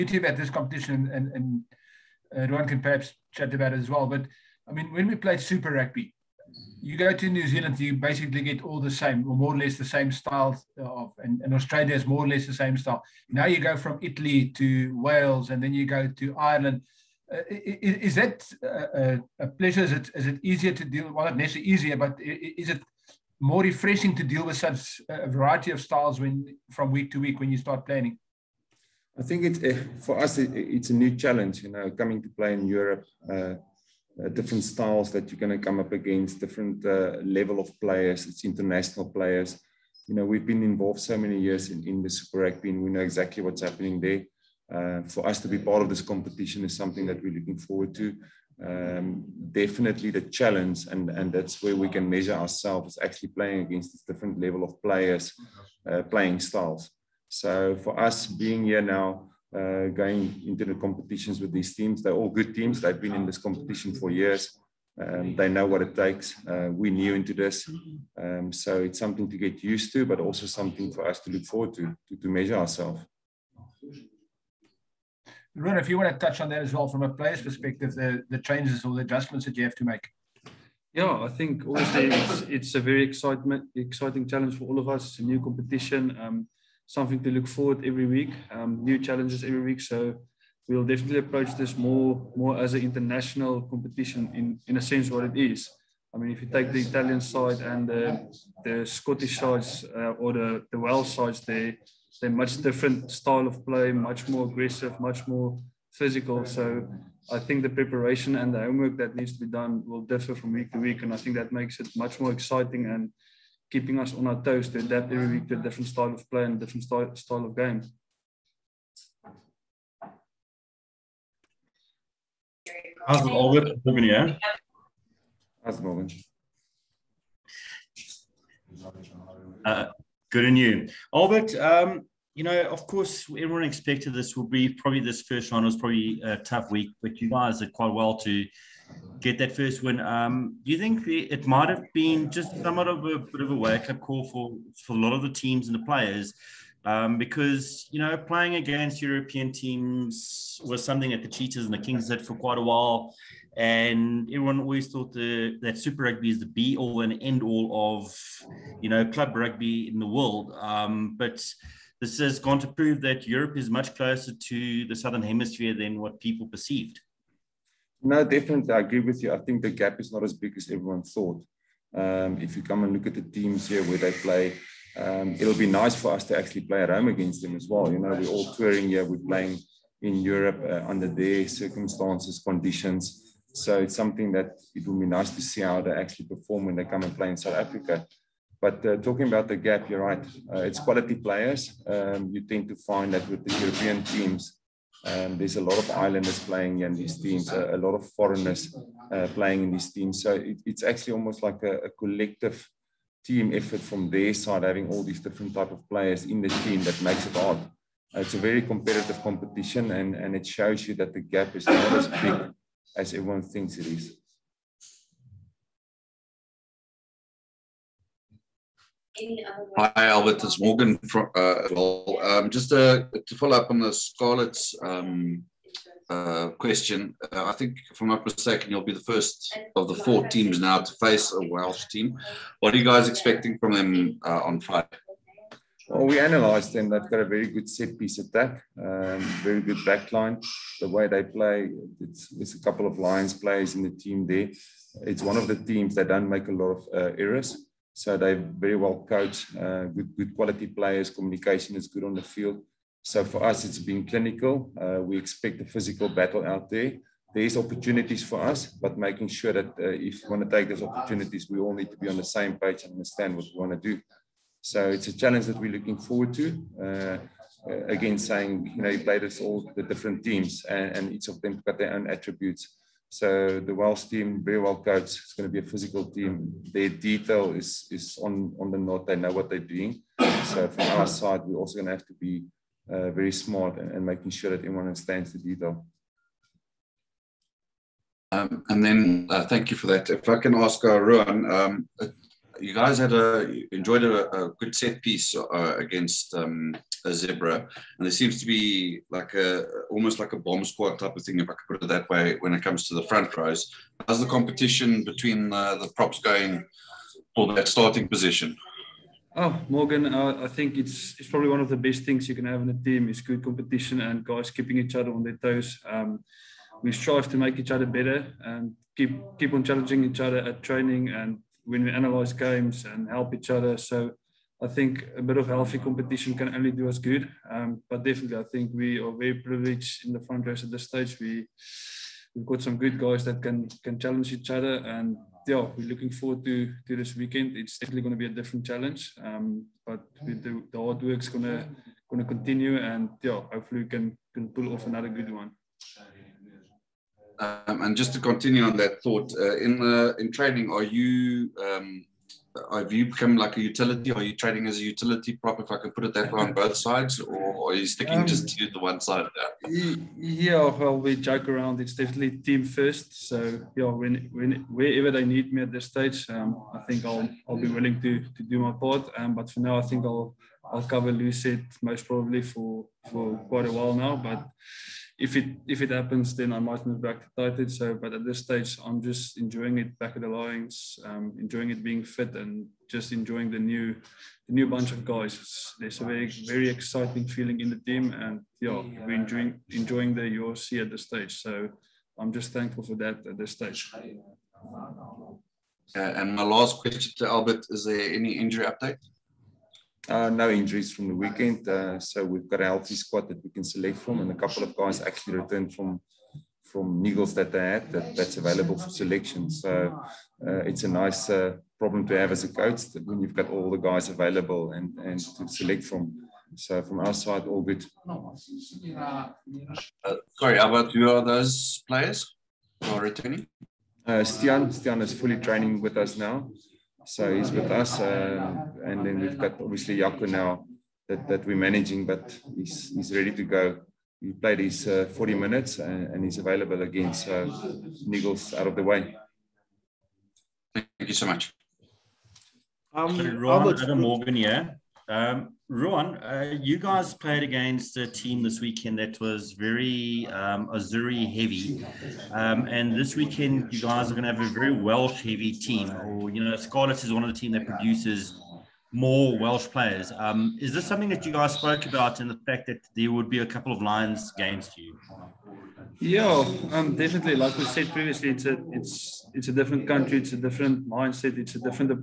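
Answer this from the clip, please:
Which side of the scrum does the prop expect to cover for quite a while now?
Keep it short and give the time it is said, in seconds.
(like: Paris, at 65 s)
loosehead, at 371 s.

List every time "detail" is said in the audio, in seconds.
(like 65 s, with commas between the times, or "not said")
276 s, 285 s.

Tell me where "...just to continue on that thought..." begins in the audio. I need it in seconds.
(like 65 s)
347 s.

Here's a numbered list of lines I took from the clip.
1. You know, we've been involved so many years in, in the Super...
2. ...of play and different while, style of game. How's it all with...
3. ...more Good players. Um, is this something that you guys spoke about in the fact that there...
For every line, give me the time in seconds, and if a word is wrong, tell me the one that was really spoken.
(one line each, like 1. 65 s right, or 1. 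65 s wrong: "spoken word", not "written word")
1. 40 s right
2. 116 s wrong: "style", not "while"
3. 458 s wrong: "Welsh", not "Good".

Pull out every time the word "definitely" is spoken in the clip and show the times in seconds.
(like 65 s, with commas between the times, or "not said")
49 s, 90 s, 168 s, 328 s, 337 s, 361 s, 466 s.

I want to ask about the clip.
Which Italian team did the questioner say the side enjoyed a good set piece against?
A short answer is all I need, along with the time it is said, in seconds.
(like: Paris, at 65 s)
Zebre, at 297 s.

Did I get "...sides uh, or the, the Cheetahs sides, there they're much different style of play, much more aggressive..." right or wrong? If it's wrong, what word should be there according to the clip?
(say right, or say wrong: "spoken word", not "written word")
wrong: "Welsh", not "Cheetahs".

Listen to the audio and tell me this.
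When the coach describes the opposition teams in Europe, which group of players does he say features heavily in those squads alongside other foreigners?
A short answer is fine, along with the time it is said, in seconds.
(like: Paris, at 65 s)
Islanders, at 195 s.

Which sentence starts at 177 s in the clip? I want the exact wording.
You know, we're all touring here, we're playing in Europe uh, under their circumstances, conditions.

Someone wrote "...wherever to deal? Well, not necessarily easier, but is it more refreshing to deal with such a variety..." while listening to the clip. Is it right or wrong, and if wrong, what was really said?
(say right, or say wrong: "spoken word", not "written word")
wrong: "easier", not "wherever".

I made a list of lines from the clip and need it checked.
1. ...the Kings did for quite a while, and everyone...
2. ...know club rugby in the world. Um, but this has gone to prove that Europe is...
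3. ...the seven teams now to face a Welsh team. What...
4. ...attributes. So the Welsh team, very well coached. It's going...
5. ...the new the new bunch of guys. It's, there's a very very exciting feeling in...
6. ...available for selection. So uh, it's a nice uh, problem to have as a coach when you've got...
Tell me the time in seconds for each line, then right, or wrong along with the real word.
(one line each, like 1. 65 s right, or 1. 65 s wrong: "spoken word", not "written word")
1. 151 s right
2. 158 s right
3. 229 s wrong: "four", not "seven"
4. 272 s right
5. 383 s right
6. 408 s right.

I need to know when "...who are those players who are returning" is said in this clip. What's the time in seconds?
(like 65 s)
420 s.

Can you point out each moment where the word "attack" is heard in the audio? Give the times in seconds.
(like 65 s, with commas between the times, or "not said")
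238 s.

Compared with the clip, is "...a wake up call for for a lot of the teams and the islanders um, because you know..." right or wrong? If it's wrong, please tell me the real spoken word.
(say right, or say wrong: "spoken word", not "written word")
wrong: "players", not "islanders".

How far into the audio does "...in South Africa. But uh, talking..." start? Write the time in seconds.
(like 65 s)
187 s.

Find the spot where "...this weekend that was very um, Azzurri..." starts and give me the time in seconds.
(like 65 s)
448 s.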